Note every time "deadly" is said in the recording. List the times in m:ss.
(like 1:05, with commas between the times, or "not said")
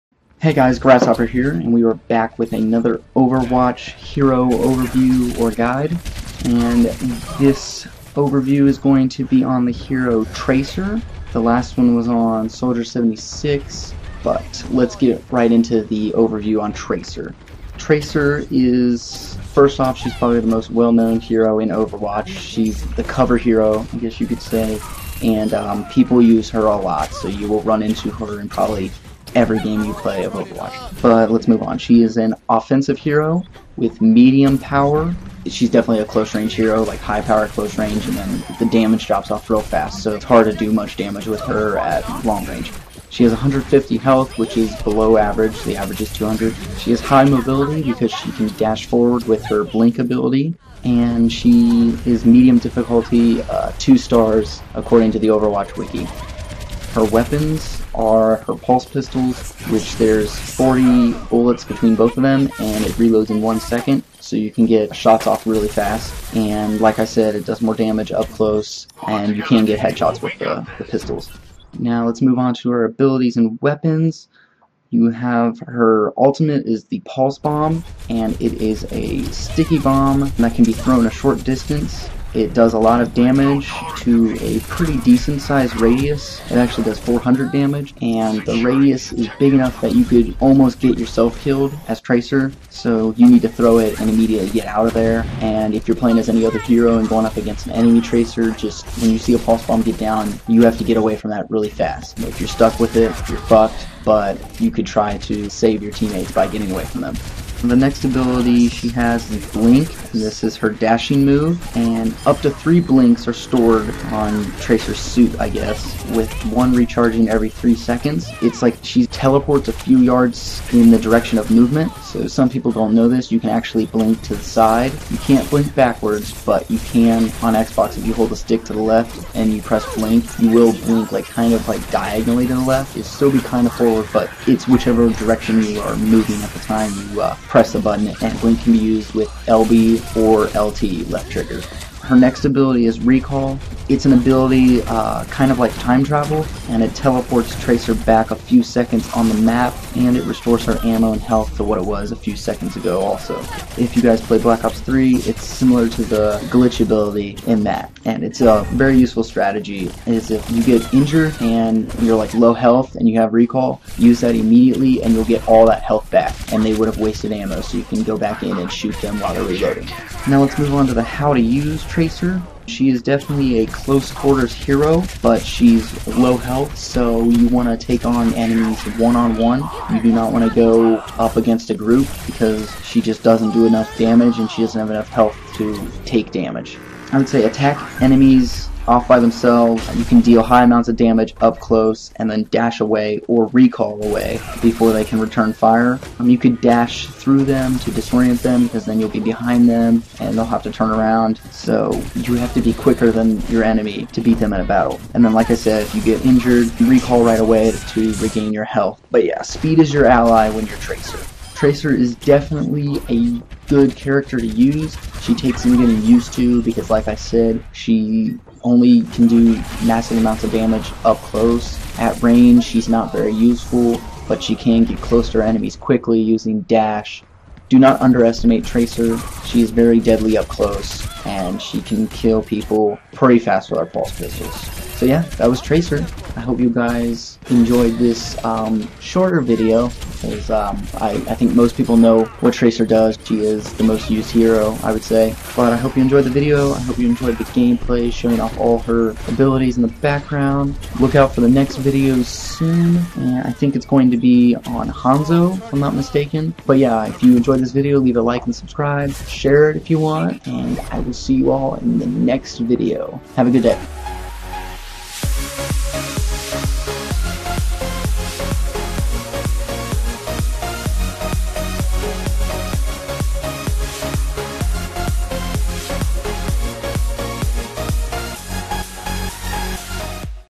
3:50.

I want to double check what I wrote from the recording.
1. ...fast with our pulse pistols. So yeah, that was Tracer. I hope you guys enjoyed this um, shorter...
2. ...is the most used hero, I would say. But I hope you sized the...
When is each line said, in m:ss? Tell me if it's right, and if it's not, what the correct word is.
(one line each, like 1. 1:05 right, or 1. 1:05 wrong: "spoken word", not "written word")
1. 3:53 right
2. 4:03 wrong: "enjoyed", not "sized".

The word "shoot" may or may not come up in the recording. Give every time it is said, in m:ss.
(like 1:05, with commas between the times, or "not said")
2:48.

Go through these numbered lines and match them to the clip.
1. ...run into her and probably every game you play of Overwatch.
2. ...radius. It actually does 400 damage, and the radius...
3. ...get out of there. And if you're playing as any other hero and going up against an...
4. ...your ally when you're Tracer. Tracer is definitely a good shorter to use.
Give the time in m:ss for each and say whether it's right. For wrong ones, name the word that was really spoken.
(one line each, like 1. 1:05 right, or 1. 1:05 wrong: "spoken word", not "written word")
1. 0:27 right
2. 1:25 right
3. 1:34 right
4. 3:29 wrong: "character", not "shorter".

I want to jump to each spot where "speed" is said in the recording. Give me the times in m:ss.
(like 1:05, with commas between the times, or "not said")
3:29.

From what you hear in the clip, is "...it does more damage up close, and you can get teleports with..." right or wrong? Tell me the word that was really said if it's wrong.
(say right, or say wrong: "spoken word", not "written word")
wrong: "headshots", not "teleports".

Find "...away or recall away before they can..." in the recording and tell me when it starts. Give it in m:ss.
3:12.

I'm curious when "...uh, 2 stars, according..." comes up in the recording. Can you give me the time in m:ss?
0:53.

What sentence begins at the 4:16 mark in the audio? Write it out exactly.
But yeah, if you enjoyed this video, leave a like and subscribe.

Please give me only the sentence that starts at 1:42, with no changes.
If you're stuck with it, you're fucked, but you could try to save your teammates by getting away from them.